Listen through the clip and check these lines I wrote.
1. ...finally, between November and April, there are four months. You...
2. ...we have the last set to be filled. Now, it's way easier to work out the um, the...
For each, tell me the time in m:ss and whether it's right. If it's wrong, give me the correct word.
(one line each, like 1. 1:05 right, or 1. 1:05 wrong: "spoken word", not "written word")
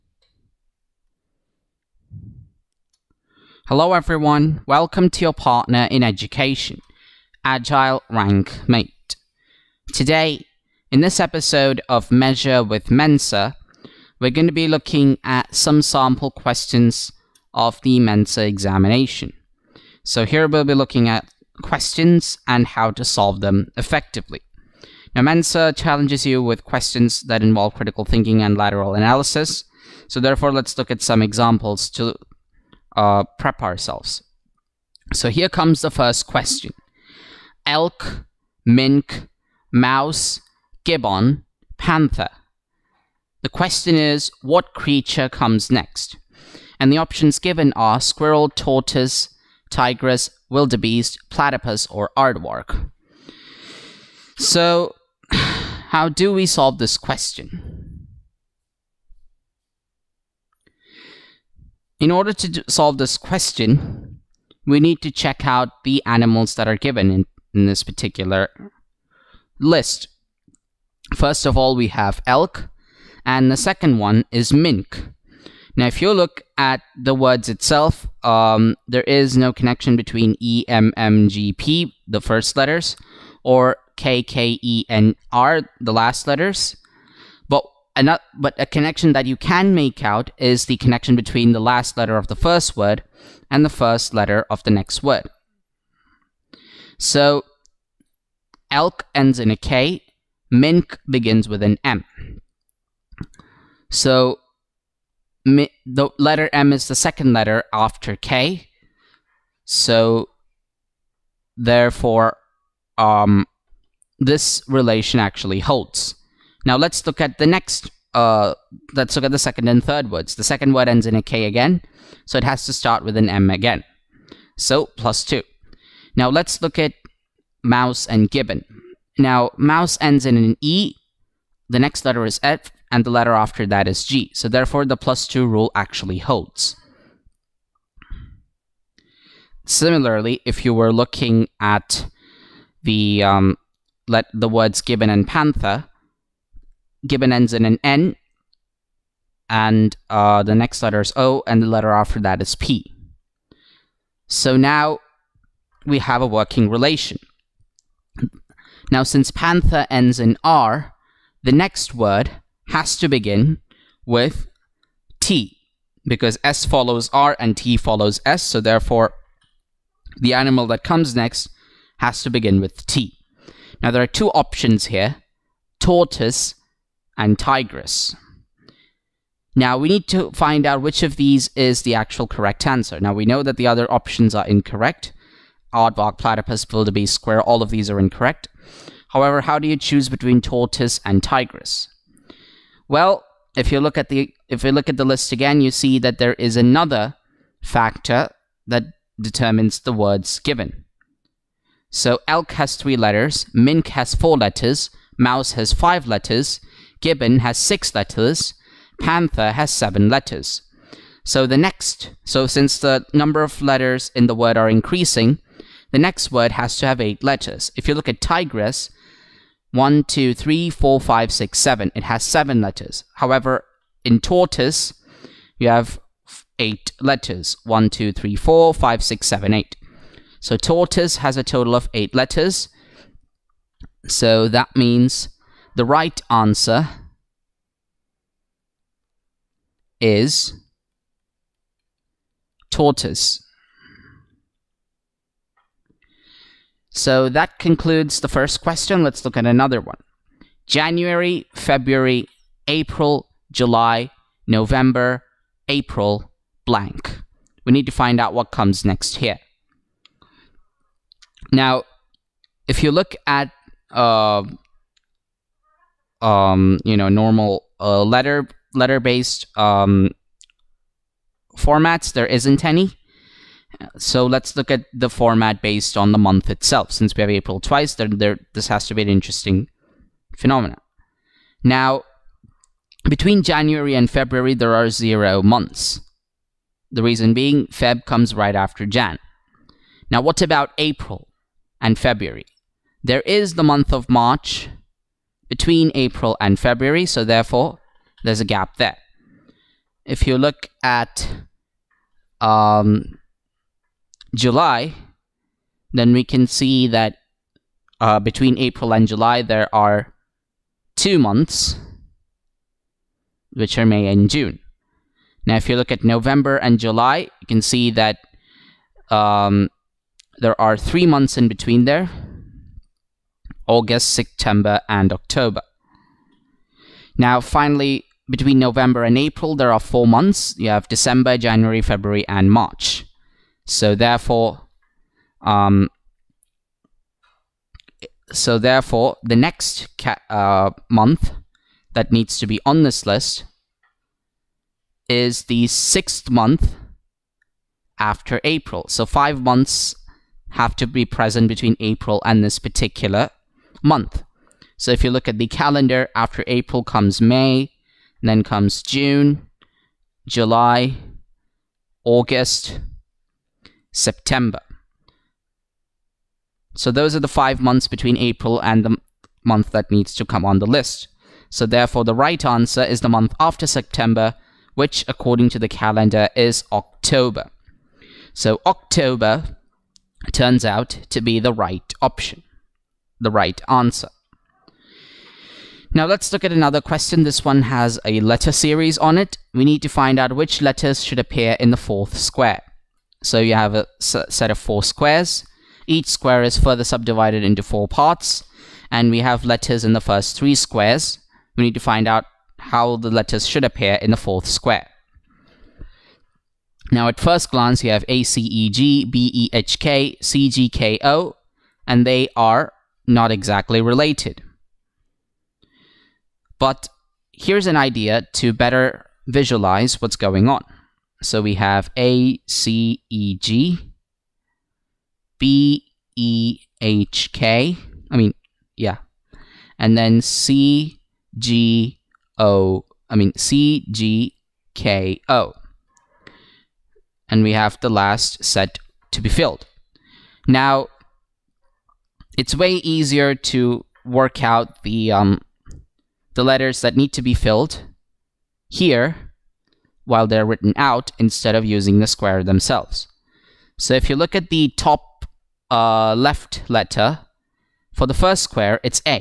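1. 5:27 right
2. 7:17 right.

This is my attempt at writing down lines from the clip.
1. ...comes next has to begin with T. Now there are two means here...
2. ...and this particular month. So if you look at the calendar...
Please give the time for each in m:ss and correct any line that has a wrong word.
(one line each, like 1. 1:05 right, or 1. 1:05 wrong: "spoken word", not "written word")
1. 2:50 wrong: "options", not "means"
2. 5:52 right.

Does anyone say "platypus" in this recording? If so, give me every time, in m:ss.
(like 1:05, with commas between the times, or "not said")
0:51, 3:06.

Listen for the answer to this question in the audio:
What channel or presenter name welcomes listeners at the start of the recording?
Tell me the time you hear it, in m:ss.
0:07.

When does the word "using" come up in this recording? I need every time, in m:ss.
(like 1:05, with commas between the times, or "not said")
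7:31.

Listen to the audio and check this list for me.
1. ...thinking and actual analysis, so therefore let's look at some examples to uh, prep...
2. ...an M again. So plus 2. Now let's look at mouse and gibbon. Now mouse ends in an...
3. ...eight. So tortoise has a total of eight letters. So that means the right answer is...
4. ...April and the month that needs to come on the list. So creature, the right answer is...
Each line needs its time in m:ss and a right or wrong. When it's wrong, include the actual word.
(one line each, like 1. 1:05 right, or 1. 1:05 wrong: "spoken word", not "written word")
1. 0:28 wrong: "lateral", not "actual"
2. 2:03 right
3. 3:49 right
4. 6:08 wrong: "therefore", not "creature".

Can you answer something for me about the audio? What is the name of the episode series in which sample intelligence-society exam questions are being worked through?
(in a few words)
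Measure with Mensa.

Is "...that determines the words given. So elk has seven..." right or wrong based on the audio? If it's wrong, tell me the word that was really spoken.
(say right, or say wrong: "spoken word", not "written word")
wrong: "three", not "seven".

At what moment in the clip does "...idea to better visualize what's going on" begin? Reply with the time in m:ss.
6:57.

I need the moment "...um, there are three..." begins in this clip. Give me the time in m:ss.
5:19.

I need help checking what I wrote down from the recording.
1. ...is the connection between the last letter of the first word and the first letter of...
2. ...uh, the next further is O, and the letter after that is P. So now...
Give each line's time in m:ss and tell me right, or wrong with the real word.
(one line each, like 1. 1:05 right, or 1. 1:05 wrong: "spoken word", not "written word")
1. 1:30 right
2. 2:30 wrong: "letter", not "further".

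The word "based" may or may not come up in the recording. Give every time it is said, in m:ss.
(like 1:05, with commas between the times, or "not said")
4:28, 4:35.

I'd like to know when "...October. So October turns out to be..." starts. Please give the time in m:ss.
6:16.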